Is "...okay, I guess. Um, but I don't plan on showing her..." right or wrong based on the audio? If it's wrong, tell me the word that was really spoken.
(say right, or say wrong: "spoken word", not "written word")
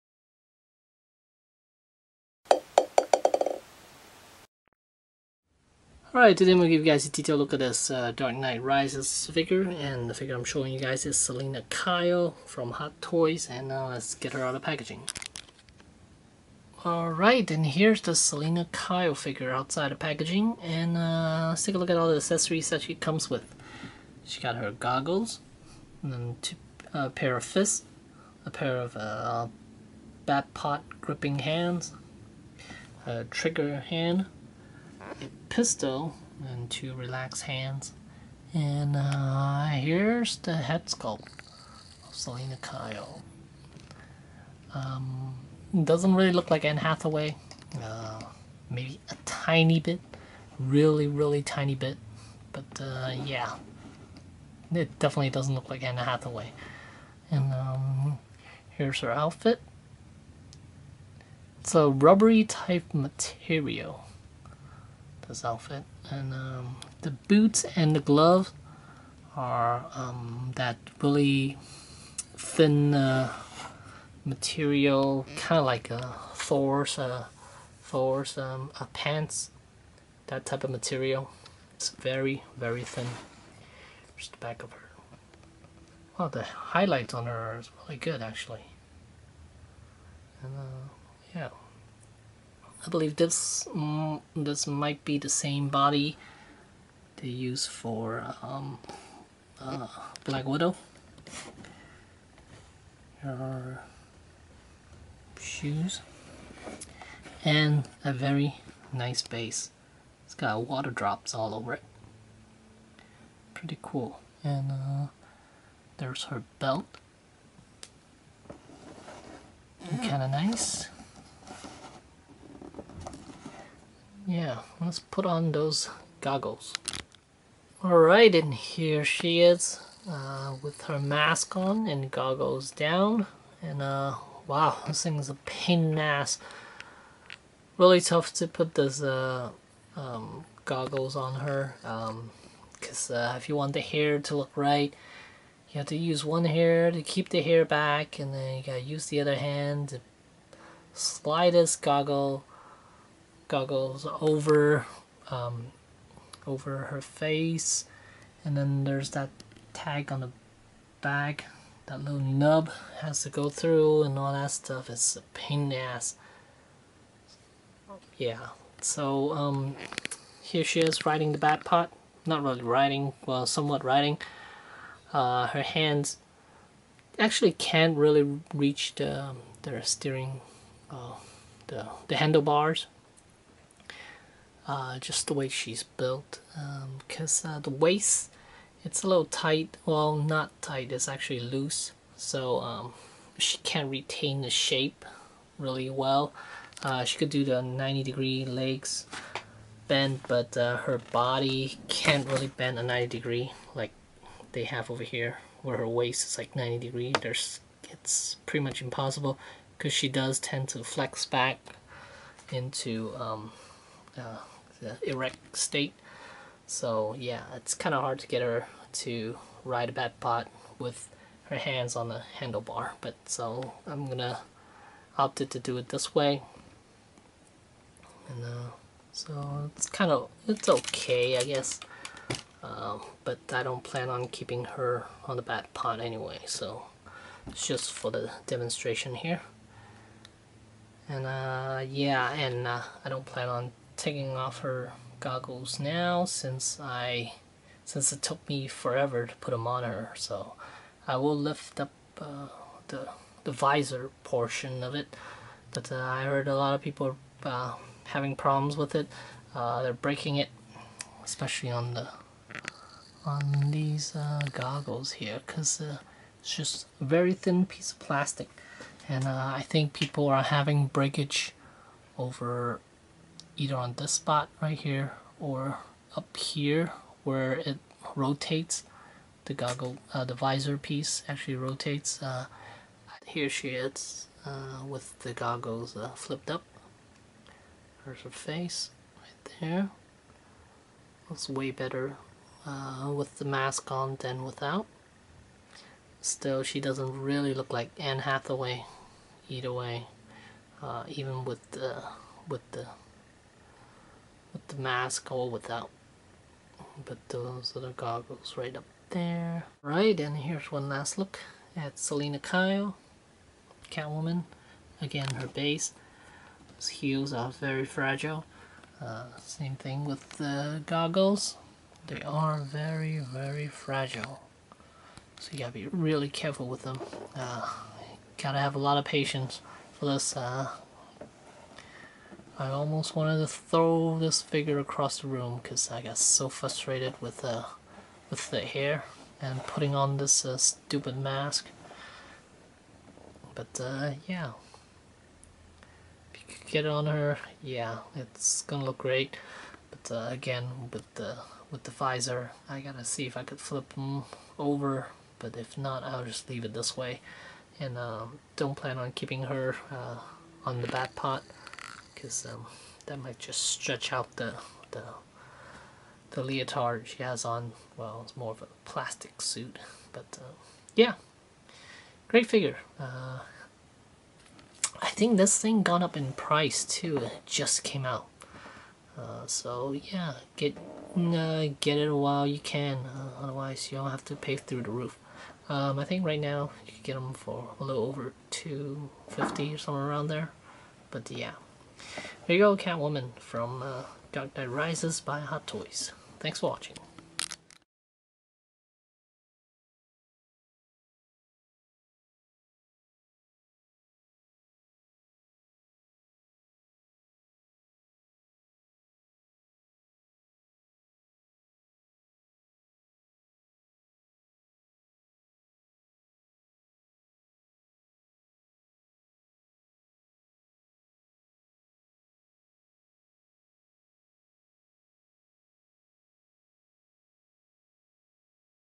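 wrong: "keeping", not "showing".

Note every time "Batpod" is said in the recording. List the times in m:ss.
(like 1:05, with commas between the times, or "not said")
0:30, 2:51, 3:39, 3:55.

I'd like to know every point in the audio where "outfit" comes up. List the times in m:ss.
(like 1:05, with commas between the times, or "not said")
0:59, 1:05.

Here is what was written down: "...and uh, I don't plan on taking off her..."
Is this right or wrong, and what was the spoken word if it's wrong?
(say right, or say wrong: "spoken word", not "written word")
right.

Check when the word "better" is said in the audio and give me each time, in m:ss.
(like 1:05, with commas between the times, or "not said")
4:51.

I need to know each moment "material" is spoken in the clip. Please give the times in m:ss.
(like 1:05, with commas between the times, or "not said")
1:02, 1:14, 1:20.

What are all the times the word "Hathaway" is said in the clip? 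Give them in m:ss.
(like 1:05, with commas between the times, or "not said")
0:46, 0:55, 4:58.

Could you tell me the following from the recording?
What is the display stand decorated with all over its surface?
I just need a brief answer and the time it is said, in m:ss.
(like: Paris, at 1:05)
water drops, at 1:50.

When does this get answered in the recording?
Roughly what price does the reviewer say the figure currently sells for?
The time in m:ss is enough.
6:28.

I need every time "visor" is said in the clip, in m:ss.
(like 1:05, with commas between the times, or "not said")
4:13, 4:40, 5:51.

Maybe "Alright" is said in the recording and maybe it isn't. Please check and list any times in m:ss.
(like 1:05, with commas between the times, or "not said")
0:06, 0:16, 2:07.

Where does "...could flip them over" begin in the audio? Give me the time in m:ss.
5:53.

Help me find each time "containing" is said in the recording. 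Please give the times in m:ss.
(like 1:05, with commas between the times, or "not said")
not said.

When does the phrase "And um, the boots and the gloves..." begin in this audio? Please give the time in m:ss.
1:06.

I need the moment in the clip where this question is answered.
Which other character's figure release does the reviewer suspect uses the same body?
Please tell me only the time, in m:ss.
1:40.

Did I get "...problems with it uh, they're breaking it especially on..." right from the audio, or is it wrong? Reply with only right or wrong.
right.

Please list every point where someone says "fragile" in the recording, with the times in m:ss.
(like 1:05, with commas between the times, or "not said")
5:17, 5:23.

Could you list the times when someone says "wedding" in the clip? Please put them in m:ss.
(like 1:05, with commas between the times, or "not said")
not said.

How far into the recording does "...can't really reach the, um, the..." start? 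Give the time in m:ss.
2:57.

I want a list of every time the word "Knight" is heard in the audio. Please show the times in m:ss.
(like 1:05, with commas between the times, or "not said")
0:08, 6:34.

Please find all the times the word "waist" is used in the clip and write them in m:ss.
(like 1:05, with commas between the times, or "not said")
3:07, 3:25.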